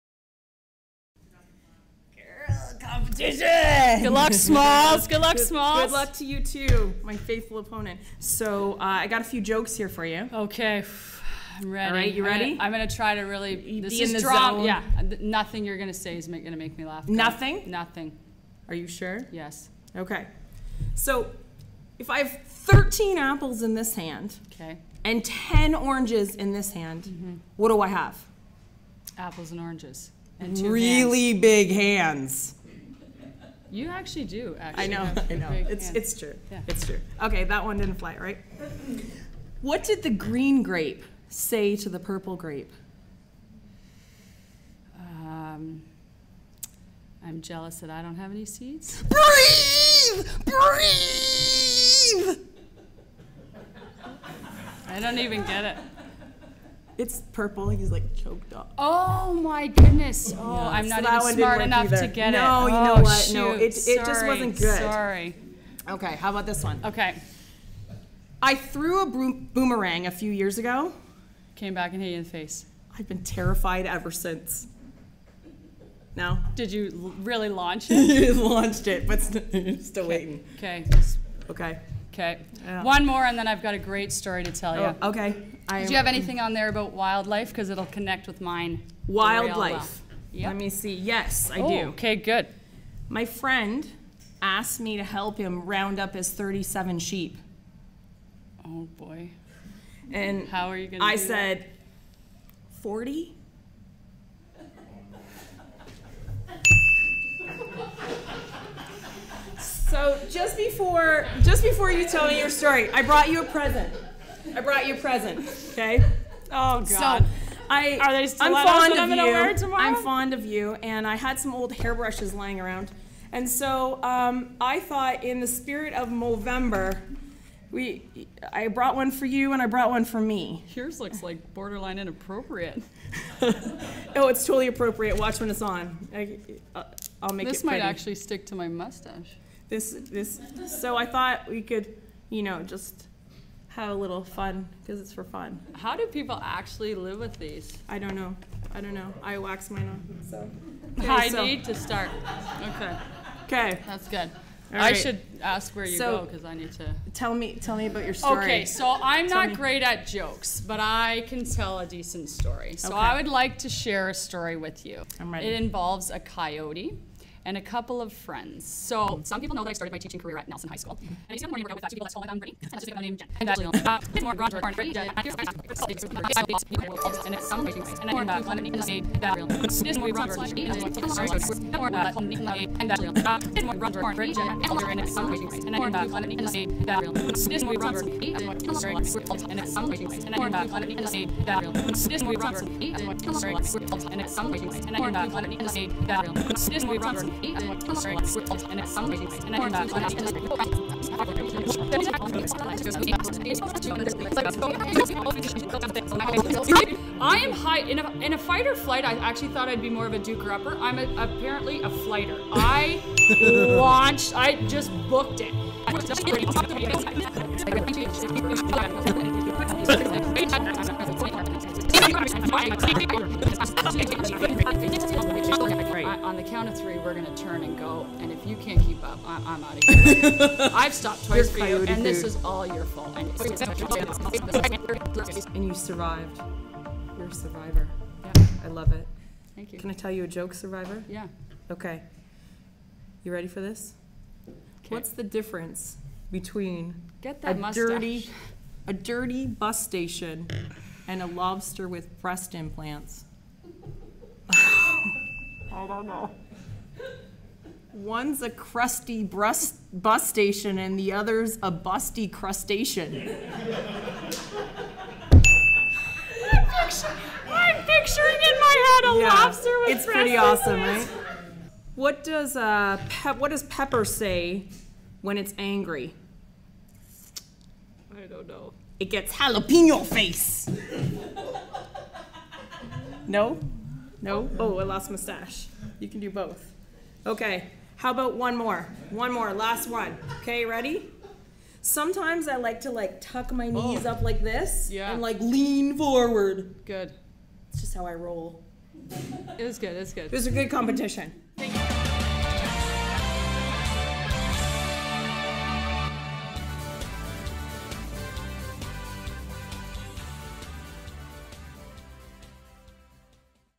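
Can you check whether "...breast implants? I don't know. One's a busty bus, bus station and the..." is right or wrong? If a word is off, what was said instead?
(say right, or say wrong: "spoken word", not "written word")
wrong: "crusty", not "busty".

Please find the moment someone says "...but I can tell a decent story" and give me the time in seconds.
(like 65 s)
160 s.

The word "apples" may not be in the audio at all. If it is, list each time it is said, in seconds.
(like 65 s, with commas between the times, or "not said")
23 s, 29 s.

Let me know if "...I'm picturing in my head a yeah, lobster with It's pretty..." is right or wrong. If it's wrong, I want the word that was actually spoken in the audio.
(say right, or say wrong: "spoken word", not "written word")
right.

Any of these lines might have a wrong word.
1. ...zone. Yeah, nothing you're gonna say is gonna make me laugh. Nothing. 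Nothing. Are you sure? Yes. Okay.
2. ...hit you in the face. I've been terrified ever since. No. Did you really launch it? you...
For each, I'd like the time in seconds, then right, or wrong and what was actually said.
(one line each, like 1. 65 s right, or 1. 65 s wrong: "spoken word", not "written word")
1. 14 s right
2. 72 s right.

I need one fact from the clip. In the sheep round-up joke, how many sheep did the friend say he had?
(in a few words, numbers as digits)
37.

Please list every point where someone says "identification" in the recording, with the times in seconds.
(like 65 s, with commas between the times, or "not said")
not said.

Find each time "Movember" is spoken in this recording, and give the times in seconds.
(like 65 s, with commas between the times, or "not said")
126 s.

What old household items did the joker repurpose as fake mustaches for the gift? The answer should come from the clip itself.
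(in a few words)
hairbrushes.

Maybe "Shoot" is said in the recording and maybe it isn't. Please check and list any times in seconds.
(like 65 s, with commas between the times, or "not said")
63 s.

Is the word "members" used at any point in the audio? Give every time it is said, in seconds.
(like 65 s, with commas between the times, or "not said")
not said.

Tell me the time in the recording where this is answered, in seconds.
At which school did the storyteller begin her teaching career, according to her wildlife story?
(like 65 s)
170 s.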